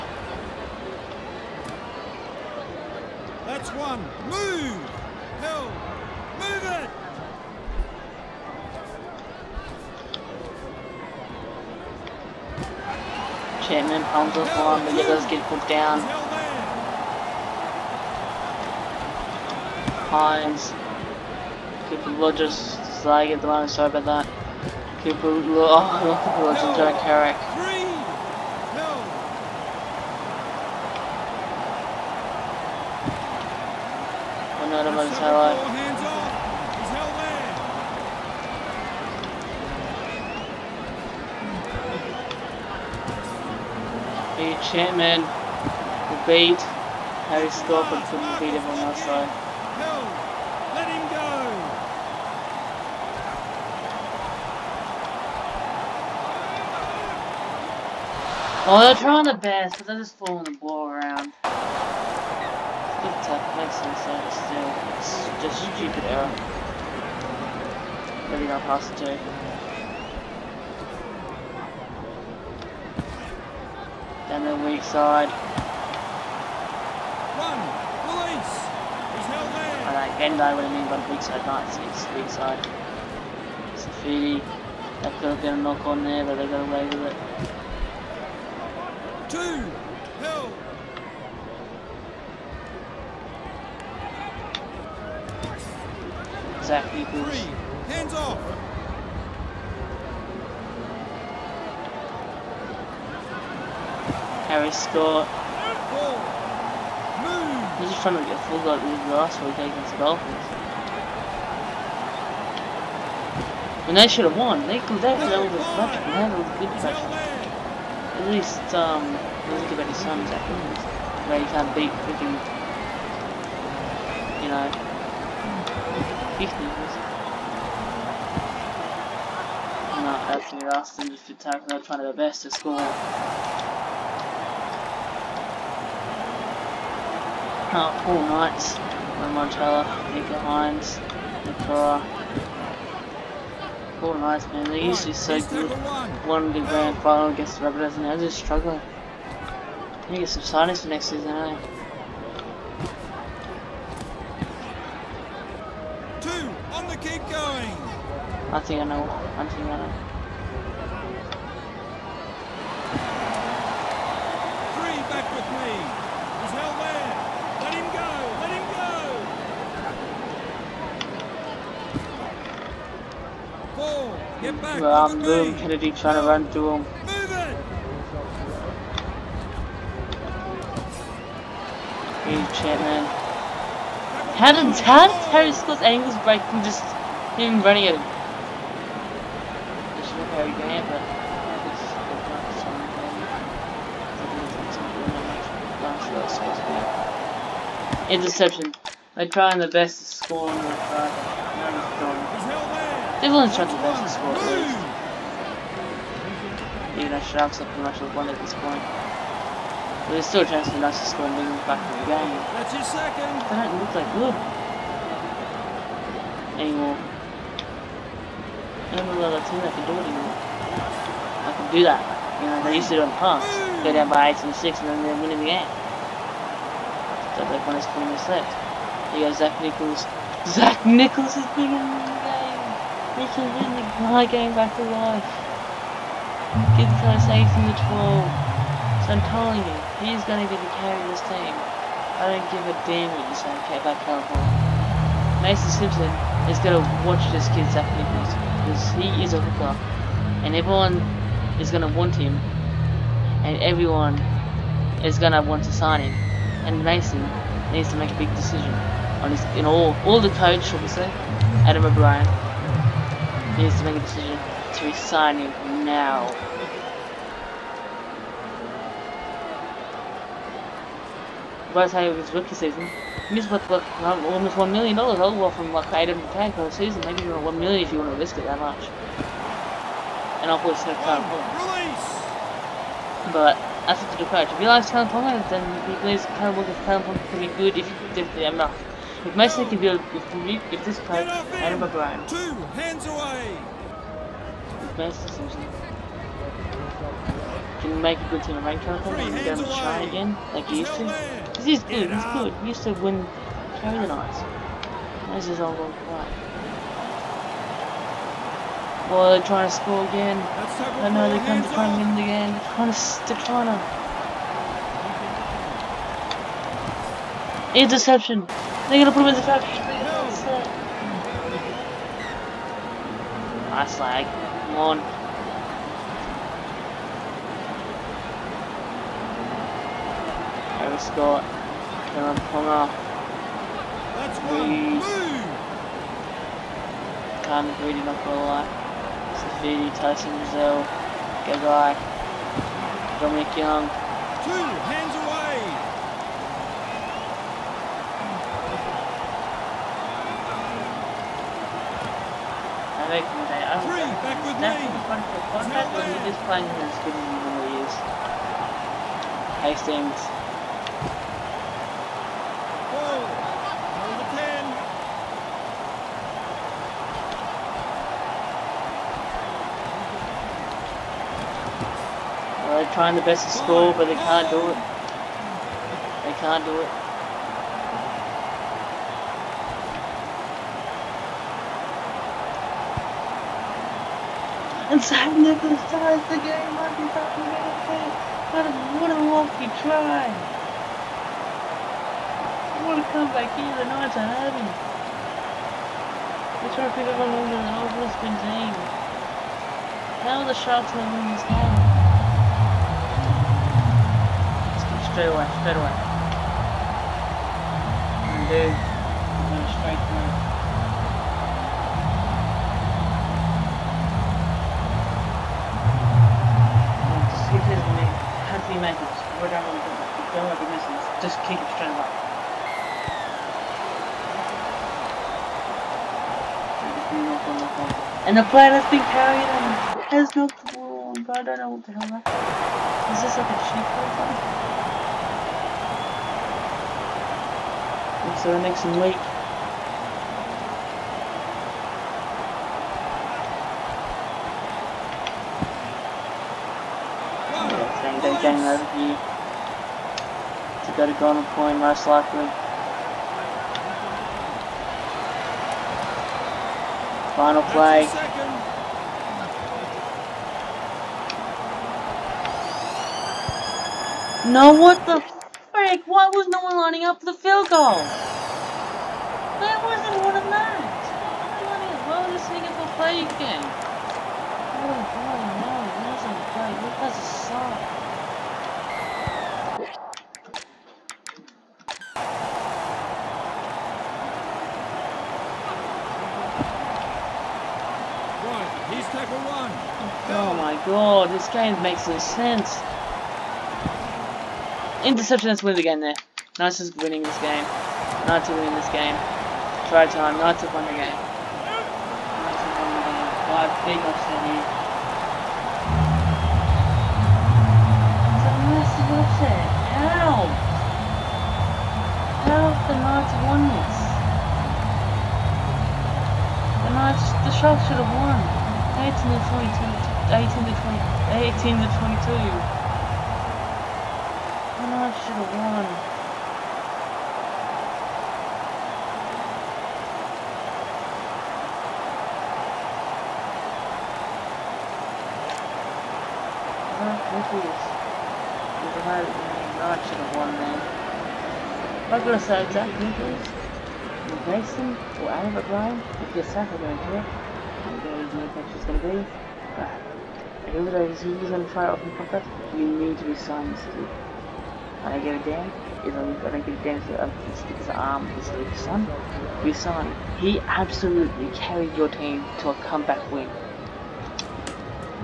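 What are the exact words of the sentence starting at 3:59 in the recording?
So I'm telling you, he's going to be the carry of this team.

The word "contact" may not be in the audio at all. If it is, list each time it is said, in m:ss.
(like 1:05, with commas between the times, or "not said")
5:55.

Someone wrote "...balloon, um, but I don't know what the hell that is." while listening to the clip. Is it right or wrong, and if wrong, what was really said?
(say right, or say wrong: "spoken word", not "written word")
right.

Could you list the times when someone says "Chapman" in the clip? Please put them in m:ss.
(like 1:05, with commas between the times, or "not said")
0:13, 3:02.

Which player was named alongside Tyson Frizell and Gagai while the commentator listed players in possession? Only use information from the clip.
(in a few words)
Dominic Young.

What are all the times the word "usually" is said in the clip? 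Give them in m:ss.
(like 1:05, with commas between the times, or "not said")
2:24.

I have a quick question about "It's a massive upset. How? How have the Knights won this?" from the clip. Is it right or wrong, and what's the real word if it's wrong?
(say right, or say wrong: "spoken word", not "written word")
right.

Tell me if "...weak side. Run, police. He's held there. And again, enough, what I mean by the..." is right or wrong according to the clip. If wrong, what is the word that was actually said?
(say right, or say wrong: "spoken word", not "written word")
wrong: "though", not "enough".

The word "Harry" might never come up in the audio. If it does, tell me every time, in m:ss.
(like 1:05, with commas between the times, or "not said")
0:47, 1:44.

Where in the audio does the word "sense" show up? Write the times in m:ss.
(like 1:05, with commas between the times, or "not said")
1:03, 8:12.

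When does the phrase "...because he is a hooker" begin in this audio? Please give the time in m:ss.
4:08.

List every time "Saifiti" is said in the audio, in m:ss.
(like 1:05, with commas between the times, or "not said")
1:23, 5:39.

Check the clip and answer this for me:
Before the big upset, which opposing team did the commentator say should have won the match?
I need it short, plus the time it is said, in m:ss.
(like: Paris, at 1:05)
Sharks, at 8:37.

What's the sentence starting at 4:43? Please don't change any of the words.
But that's up to the crowd.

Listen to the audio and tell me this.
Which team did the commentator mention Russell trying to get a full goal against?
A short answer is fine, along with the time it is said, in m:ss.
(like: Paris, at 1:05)
Dolphins, at 1:49.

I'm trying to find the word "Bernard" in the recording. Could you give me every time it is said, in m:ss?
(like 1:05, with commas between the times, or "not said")
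8:44, 8:56.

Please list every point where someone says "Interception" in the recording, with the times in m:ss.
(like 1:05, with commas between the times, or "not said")
3:18, 5:17, 8:15.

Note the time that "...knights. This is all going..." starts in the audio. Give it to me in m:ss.
5:04.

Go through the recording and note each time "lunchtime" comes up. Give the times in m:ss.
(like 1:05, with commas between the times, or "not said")
not said.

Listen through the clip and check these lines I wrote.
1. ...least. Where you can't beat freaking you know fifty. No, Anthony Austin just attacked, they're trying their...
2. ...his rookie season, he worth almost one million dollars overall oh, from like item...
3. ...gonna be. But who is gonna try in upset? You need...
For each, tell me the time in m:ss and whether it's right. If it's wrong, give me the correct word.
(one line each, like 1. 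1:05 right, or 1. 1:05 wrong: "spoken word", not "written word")
1. 2:00 right
2. 4:32 right
3. 9:08 wrong: "pocket", not "upset".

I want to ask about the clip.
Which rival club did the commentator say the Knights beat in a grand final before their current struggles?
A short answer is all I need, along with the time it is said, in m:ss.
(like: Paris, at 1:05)
Rabbitohs, at 2:27.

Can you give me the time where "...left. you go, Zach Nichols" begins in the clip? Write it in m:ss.
3:48.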